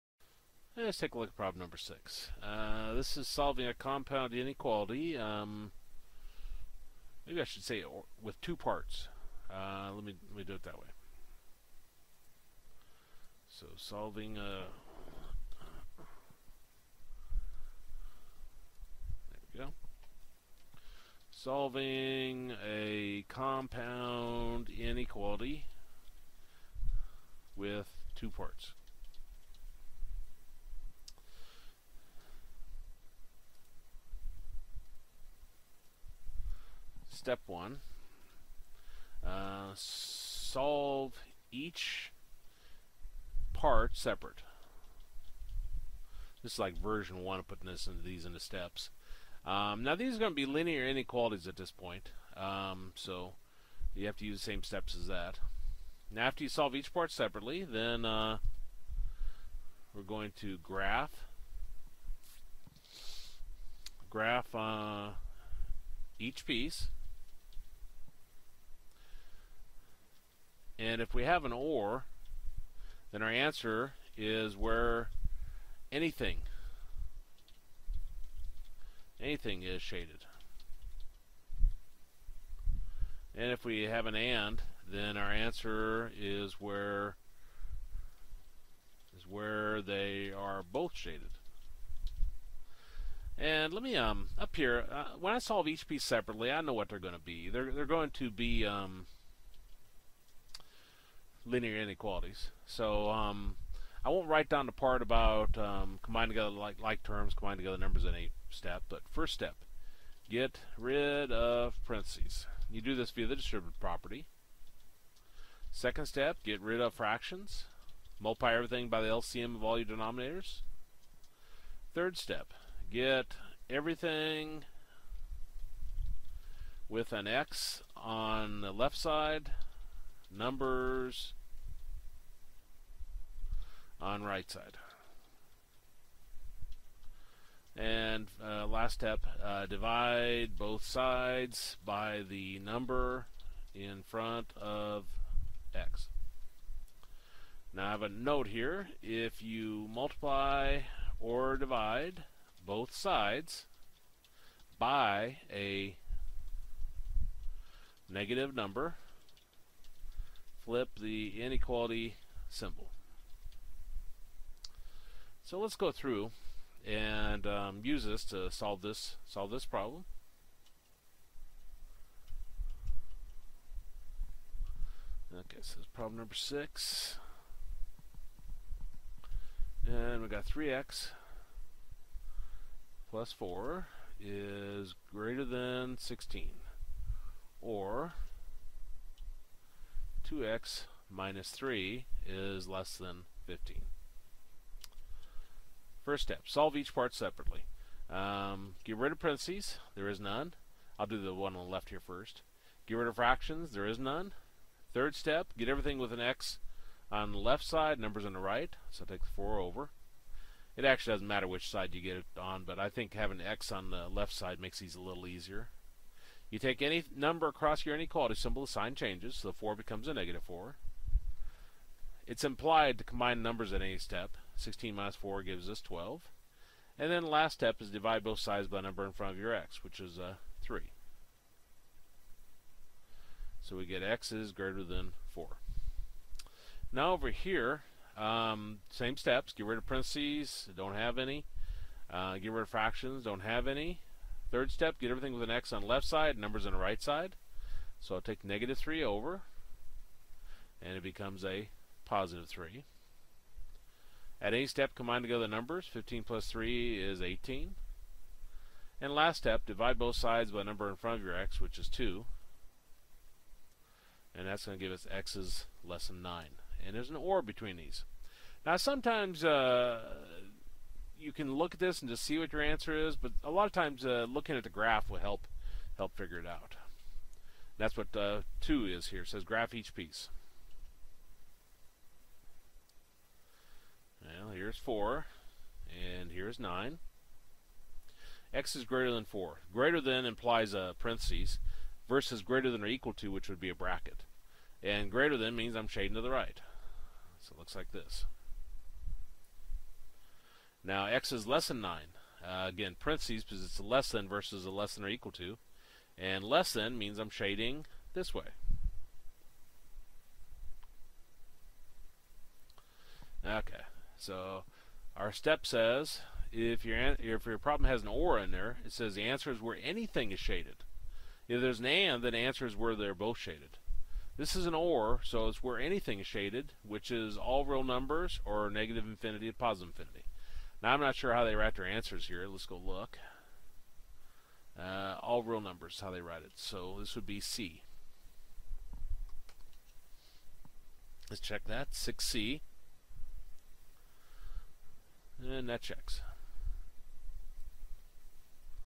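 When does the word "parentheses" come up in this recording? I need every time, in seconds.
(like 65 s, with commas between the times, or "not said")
111 s, 199 s, 239 s, 290 s, 302 s.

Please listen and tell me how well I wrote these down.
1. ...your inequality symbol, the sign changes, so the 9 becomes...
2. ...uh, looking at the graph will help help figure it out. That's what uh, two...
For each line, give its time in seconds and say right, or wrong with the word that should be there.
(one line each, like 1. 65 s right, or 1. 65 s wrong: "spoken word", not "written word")
1. 217 s wrong: "4", not "9"
2. 274 s right.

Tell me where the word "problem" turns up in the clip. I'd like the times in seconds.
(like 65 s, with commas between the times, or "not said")
1 s, 169 s, 175 s, 317 s.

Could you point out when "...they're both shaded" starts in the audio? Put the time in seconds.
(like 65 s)
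322 s.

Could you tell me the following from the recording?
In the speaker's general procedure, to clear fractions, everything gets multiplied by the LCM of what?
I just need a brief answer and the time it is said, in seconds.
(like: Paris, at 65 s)
all your denominators, at 119 s.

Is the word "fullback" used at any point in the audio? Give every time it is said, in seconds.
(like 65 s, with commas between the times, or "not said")
not said.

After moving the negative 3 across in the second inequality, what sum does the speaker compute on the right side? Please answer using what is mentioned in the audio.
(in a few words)
18.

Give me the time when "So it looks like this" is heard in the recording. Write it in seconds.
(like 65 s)
297 s.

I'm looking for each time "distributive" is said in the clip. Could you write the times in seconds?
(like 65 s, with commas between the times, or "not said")
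113 s.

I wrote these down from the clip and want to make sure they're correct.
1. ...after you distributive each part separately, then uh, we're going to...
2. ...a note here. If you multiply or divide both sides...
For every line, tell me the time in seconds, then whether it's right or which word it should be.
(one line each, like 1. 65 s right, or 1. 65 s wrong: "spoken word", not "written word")
1. 56 s wrong: "solve", not "distributive"
2. 148 s right.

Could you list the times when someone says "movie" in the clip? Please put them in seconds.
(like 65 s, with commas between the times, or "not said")
not said.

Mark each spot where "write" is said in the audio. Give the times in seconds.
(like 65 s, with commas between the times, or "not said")
104 s, 331 s, 336 s.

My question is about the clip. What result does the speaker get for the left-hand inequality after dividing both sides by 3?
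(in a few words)
x is greater than 4.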